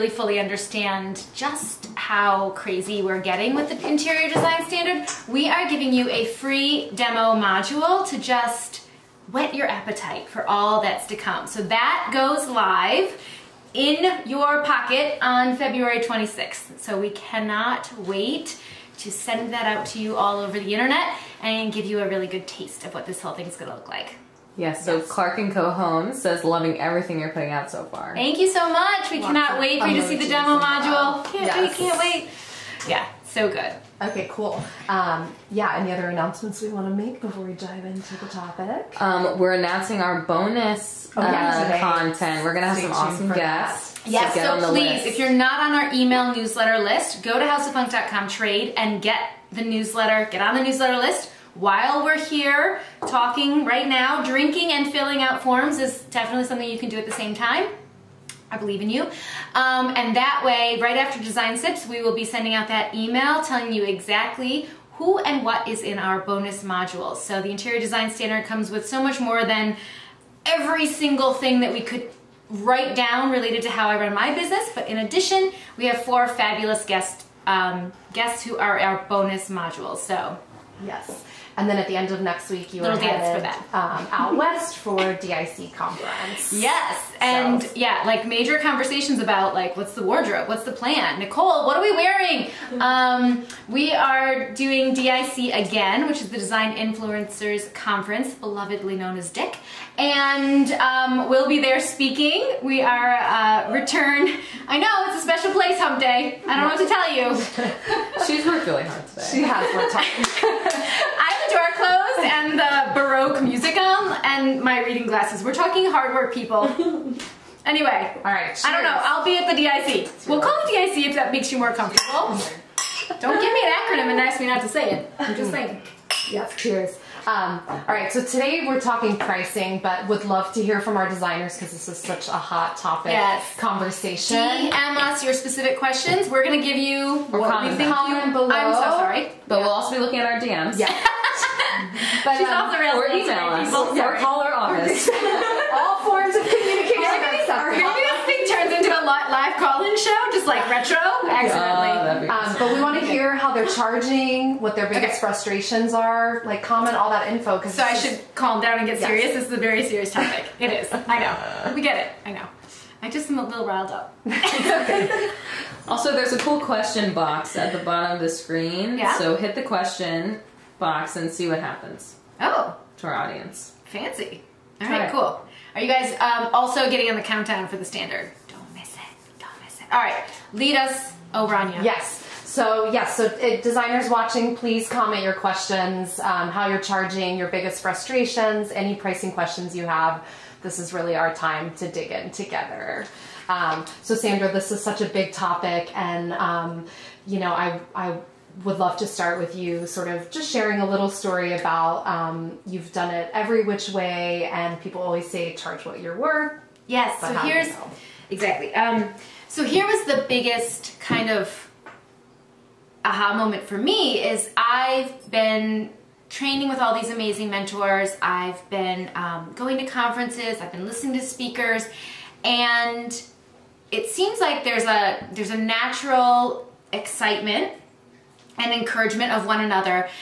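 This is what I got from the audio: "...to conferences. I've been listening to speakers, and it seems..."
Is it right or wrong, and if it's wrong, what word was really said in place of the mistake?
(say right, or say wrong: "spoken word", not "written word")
right.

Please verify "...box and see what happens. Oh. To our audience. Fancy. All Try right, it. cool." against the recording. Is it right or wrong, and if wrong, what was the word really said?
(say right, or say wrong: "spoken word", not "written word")
right.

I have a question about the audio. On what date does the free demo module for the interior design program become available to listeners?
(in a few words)
February 26th.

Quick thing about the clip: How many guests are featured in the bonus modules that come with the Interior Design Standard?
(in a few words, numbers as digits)
4.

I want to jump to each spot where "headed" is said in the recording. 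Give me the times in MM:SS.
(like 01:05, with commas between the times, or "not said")
01:23.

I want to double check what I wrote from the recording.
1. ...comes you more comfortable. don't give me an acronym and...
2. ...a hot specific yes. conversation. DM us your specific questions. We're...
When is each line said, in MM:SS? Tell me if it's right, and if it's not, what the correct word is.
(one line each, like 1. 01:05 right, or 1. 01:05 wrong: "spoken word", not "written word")
1. 02:01 wrong: "makes", not "comes"
2. 02:12 wrong: "topic", not "specific".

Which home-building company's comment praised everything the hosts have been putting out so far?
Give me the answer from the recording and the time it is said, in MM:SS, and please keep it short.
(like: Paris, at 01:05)
Clark and Co. Homes, at 00:25.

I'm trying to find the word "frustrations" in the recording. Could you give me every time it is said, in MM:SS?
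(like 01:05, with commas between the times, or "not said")
02:35, 03:07.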